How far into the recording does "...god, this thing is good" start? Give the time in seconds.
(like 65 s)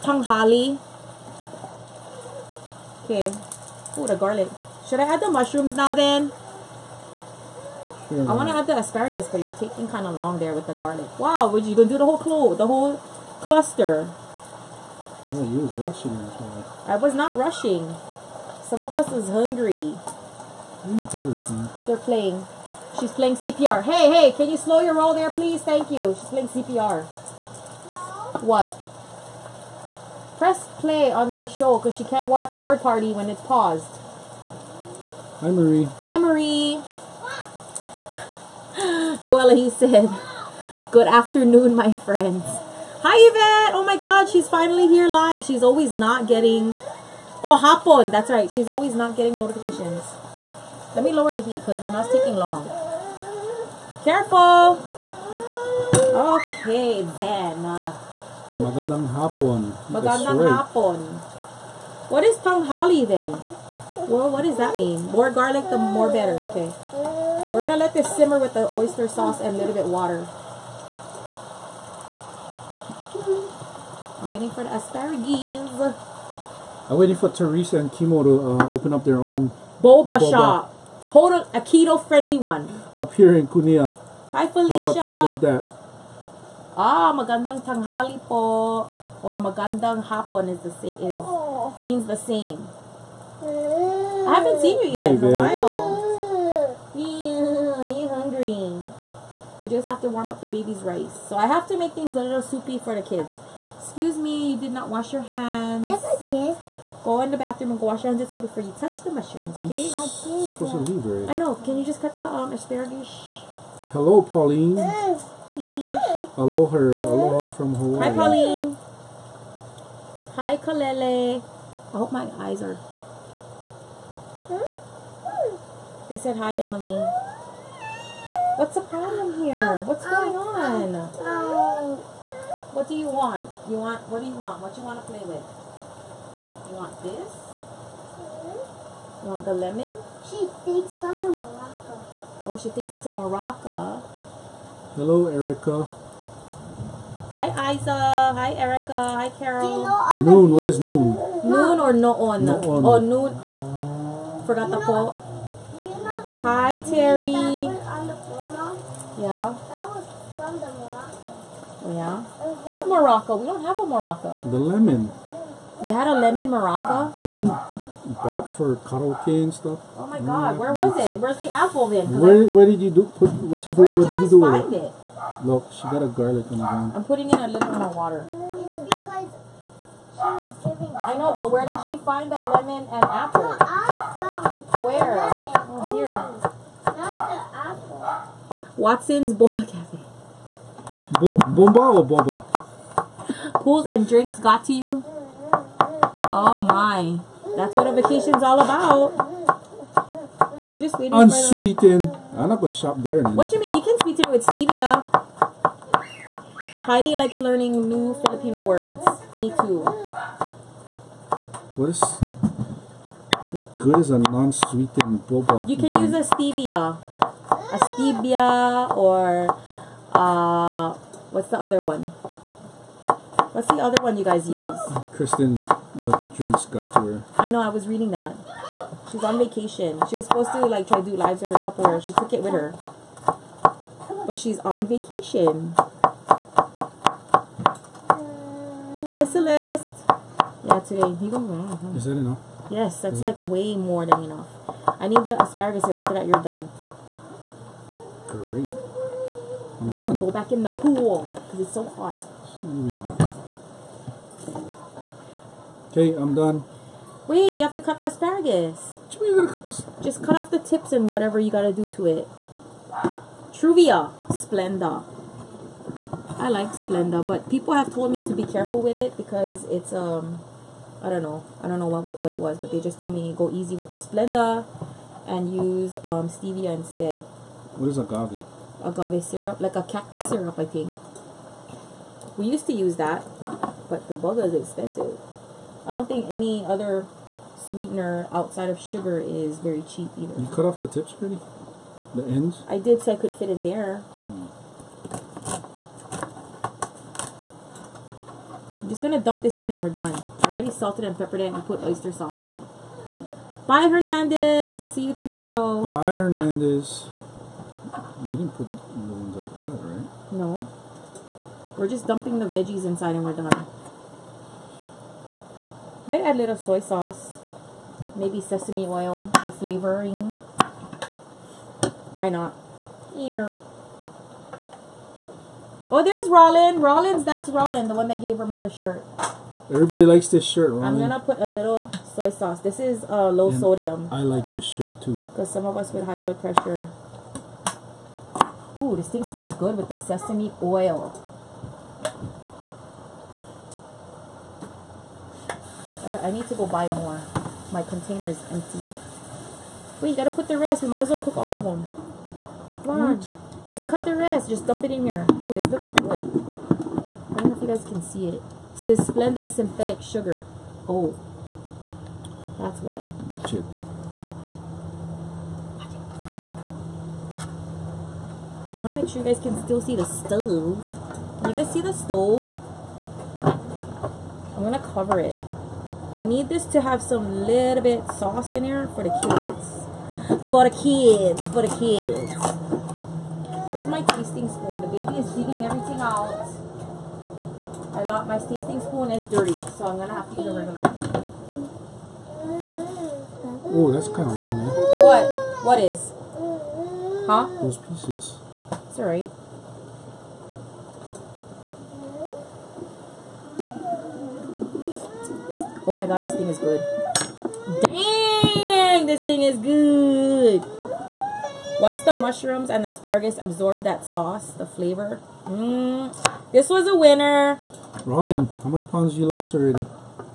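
406 s.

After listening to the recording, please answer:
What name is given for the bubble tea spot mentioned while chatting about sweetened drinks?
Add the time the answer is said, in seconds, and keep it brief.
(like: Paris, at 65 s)
Watson's Boba Cafe, at 188 s.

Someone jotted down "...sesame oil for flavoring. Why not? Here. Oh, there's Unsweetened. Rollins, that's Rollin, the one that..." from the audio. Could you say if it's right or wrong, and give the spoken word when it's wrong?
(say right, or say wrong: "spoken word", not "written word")
wrong: "Rollin", not "Unsweetened".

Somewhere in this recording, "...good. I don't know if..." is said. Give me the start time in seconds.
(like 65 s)
355 s.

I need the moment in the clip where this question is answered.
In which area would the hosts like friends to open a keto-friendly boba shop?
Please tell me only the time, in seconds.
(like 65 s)
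83 s.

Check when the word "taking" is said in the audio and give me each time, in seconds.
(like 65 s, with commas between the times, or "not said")
9 s, 52 s.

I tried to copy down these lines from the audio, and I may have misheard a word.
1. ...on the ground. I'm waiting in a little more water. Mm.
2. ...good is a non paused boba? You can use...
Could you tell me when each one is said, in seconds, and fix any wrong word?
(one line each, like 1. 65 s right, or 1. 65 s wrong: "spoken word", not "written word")
1. 176 s wrong: "putting", not "waiting"
2. 213 s wrong: "sweetened", not "paused".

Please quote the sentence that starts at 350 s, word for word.
Wait, you gotta put the rest.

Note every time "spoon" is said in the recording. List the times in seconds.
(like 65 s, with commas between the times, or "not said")
384 s, 388 s.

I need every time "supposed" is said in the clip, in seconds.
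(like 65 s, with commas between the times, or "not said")
110 s, 230 s.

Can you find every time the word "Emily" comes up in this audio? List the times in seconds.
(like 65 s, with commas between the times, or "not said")
126 s.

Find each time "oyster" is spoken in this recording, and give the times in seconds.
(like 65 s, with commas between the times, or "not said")
68 s, 301 s.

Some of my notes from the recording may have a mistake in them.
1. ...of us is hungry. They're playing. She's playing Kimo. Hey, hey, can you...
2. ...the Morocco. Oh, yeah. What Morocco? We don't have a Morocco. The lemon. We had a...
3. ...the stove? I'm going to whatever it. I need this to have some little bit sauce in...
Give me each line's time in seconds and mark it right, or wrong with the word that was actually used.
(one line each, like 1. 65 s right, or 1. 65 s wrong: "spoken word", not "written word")
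1. 18 s wrong: "CPR", not "Kimo"
2. 160 s right
3. 371 s wrong: "cover", not "whatever".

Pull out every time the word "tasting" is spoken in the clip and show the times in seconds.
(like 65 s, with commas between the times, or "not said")
384 s, 388 s.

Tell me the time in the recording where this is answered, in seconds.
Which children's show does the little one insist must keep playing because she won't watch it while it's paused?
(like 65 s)
32 s.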